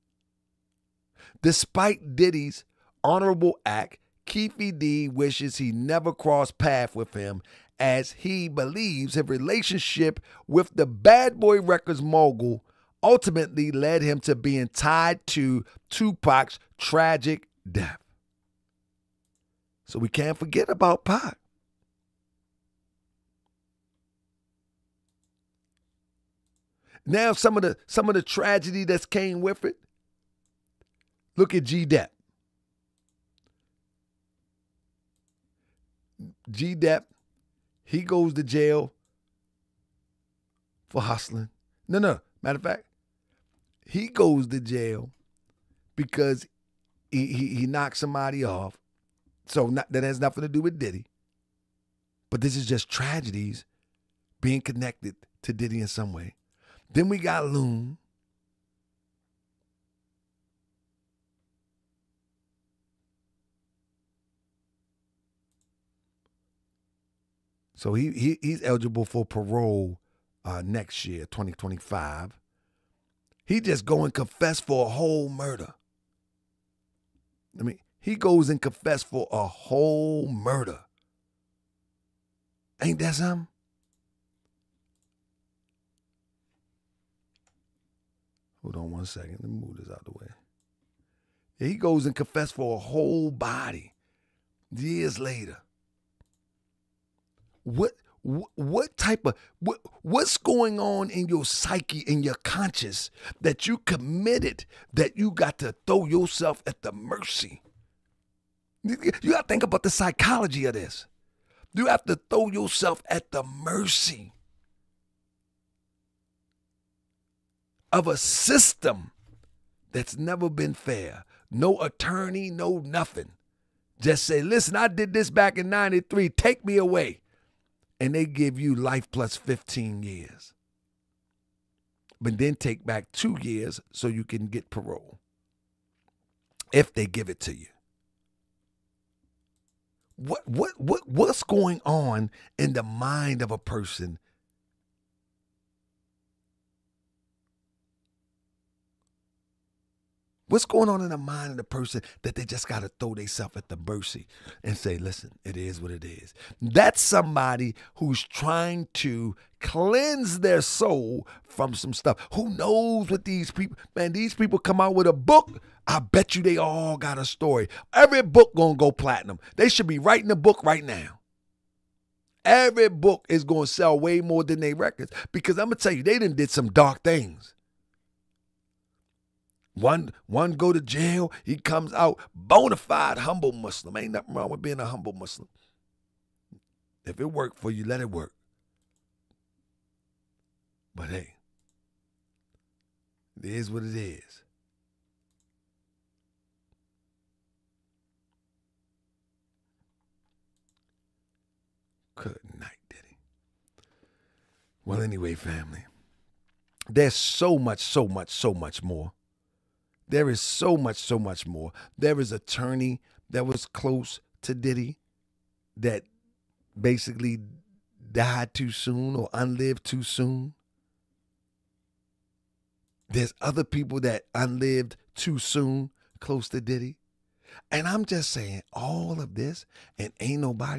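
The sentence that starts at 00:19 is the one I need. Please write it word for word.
So we can't forget about Pac.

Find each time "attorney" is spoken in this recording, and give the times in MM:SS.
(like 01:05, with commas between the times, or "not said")
02:01, 03:32.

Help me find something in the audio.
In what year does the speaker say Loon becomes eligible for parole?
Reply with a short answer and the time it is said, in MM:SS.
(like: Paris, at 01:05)
2025, at 01:11.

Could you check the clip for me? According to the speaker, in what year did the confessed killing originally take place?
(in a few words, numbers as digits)
1993.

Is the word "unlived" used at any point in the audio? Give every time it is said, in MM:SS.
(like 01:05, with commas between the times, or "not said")
03:39, 03:44.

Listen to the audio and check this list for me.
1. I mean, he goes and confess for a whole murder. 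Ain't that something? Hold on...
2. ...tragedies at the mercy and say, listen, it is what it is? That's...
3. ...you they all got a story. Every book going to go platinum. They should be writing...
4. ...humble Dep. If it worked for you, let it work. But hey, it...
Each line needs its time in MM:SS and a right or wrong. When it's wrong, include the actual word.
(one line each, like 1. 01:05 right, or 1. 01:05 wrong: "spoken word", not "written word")
1. 01:17 right
2. 02:33 wrong: "themselves", not "tragedies"
3. 02:46 right
4. 03:04 wrong: "Muslim", not "Dep".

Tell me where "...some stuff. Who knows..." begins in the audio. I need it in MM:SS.
02:41.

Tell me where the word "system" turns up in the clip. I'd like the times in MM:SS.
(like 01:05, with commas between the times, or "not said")
01:58.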